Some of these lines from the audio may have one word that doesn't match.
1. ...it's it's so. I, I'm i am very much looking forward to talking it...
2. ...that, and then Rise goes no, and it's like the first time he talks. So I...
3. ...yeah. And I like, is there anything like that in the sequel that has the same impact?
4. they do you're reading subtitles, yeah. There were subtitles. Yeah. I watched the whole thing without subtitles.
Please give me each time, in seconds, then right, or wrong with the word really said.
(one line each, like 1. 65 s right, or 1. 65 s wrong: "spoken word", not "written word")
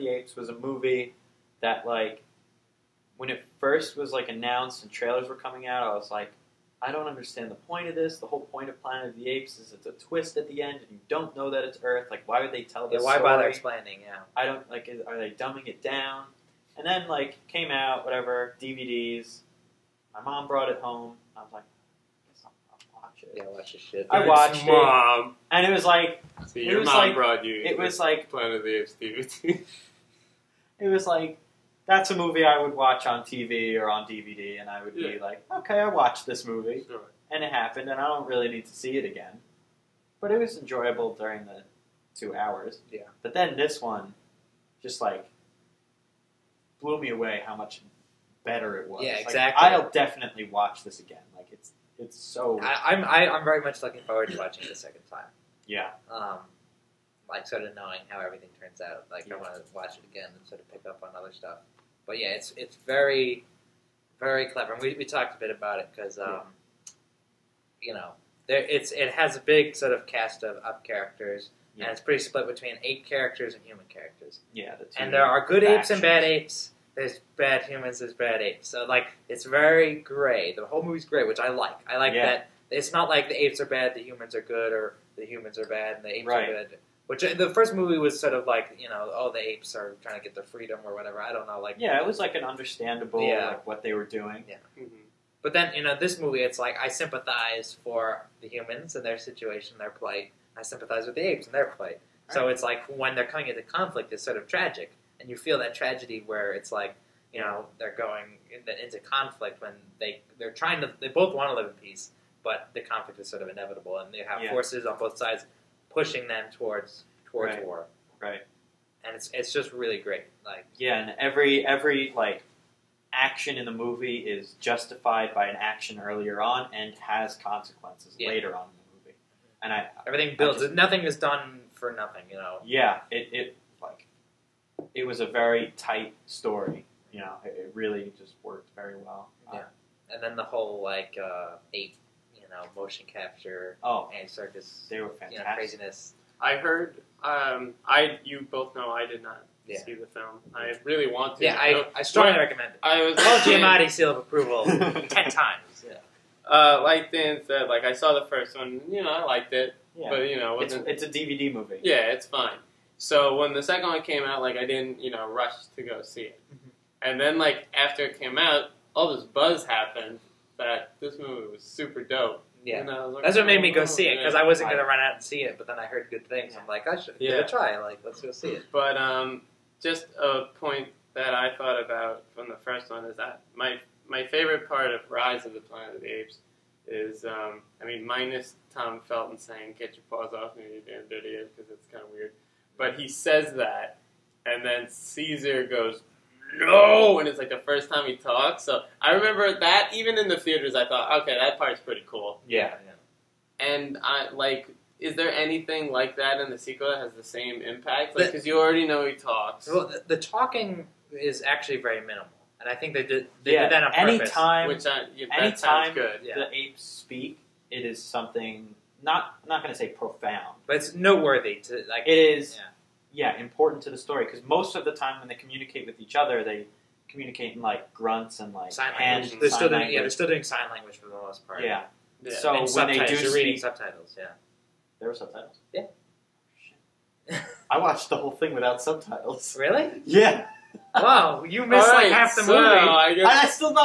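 1. 51 s wrong: "watching", not "talking"
2. 193 s wrong: "Caesar", not "Rise"
3. 202 s right
4. 232 s right.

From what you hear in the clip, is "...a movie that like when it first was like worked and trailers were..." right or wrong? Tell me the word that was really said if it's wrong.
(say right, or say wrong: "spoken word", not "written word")
wrong: "announced", not "worked".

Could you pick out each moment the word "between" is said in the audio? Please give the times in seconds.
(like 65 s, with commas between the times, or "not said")
72 s.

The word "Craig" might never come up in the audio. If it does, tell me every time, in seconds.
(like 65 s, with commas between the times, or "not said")
not said.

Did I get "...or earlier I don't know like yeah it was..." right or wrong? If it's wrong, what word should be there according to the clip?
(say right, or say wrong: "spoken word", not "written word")
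wrong: "whatever", not "earlier".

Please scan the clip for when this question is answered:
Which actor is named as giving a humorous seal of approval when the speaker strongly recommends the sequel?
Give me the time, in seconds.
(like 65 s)
153 s.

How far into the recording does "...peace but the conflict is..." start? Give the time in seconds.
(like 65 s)
111 s.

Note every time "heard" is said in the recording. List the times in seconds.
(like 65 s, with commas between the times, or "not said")
146 s, 175 s.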